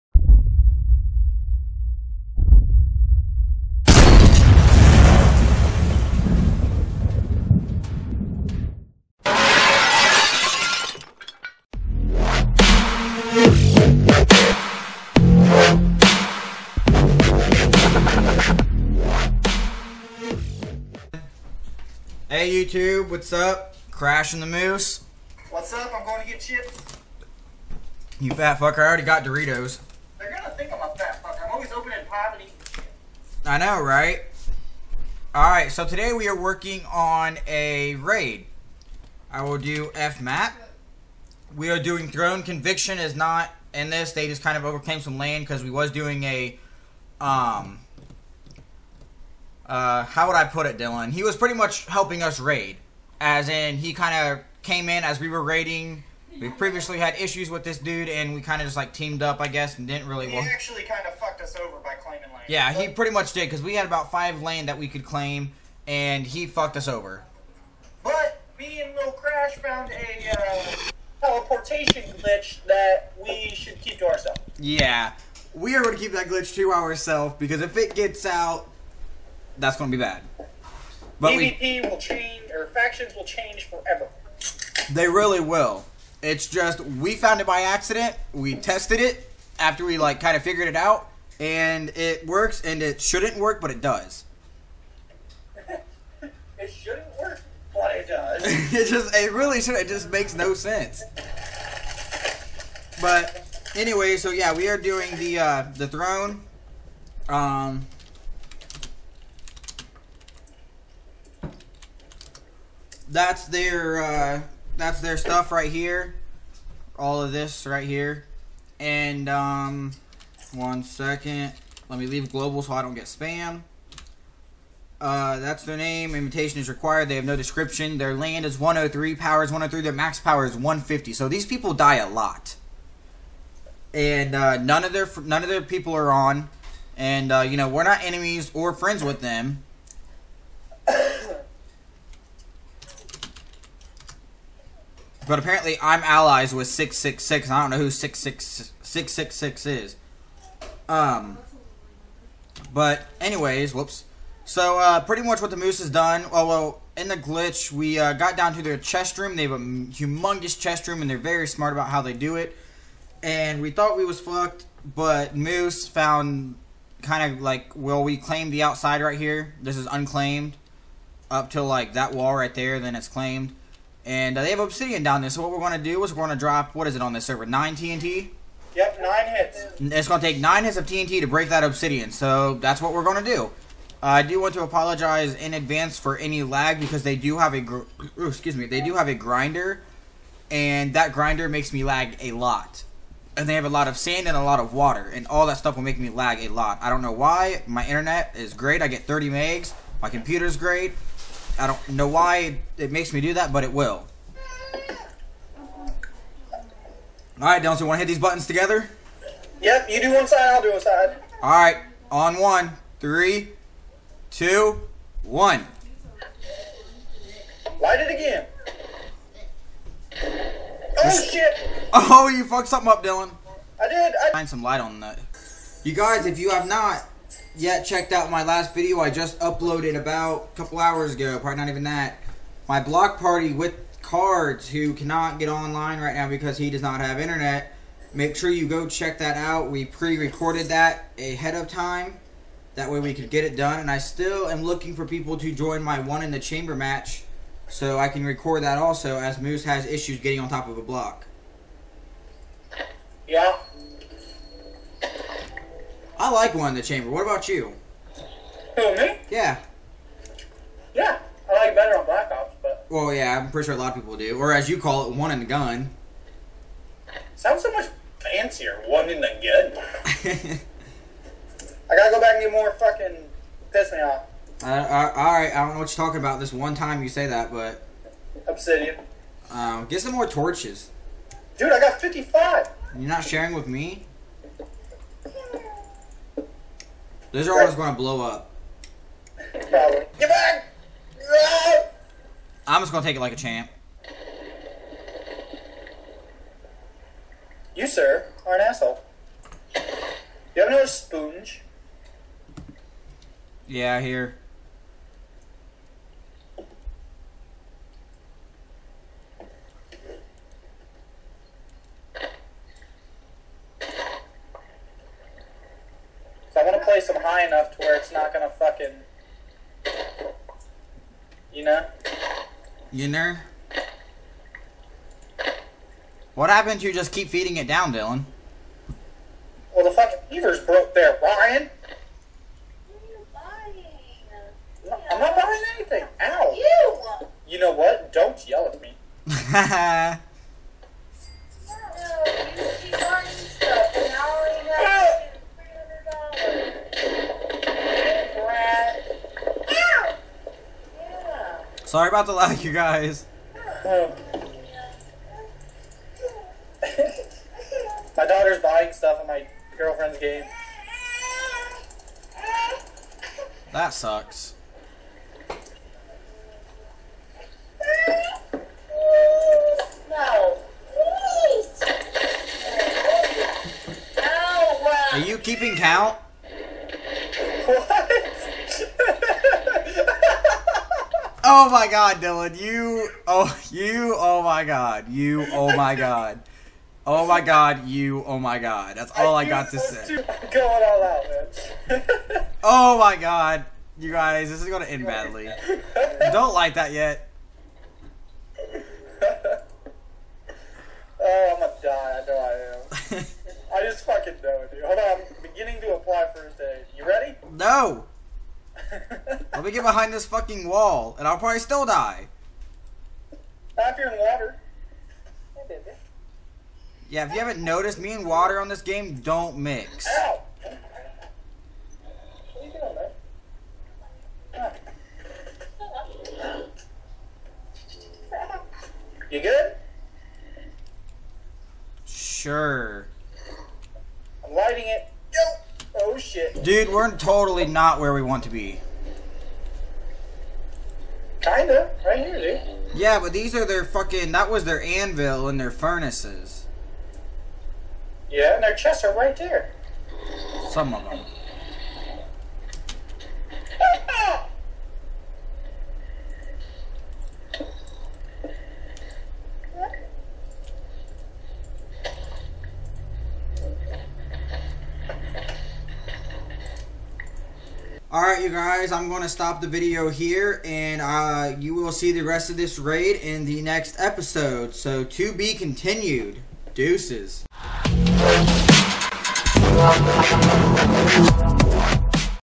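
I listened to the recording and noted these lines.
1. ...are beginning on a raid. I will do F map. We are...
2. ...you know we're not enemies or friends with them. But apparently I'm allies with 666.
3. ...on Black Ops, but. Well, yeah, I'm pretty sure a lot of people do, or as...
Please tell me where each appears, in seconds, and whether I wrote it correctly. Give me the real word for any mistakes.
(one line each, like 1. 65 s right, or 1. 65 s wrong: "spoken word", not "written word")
1. 36 s wrong: "working", not "beginning"
2. 137 s right
3. 261 s right.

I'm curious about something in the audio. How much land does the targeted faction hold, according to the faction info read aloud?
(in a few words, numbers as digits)
103.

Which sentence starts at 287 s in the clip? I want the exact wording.
This are always going to blow up.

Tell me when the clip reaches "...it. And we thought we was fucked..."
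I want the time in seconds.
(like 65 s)
162 s.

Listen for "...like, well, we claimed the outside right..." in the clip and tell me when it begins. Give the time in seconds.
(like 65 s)
167 s.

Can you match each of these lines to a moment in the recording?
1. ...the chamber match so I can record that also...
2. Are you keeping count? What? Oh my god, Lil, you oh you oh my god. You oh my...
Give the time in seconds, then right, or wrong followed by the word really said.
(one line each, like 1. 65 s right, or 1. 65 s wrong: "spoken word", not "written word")
1. 246 s right
2. 375 s wrong: "Dylan", not "Lil".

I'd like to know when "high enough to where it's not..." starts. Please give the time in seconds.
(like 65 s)
317 s.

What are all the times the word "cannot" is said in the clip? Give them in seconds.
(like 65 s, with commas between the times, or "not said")
234 s.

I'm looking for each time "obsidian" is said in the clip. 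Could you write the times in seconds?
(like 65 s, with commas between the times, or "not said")
174 s, 181 s, 278 s.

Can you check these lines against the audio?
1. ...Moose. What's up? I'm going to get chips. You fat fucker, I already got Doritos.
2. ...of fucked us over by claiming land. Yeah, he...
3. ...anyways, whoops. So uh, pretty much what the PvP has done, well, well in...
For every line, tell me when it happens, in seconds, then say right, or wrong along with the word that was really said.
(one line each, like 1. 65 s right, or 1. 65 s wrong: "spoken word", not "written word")
1. 24 s right
2. 61 s right
3. 153 s wrong: "Moose", not "PvP".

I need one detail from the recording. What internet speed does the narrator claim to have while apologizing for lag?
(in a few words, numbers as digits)
30 megs.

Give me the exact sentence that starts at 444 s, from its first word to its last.
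That was their anvil and their furnaces.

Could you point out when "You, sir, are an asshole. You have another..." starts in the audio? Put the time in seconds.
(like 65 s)
297 s.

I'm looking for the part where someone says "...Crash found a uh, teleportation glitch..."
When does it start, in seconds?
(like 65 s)
69 s.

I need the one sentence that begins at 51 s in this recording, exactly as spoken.
He was pretty much helping us raid, as in he kind of came in as we were raiding.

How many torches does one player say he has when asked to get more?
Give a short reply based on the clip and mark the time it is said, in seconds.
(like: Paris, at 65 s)
55, at 281 s.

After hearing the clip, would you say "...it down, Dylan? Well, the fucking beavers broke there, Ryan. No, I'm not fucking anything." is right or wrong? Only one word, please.
wrong.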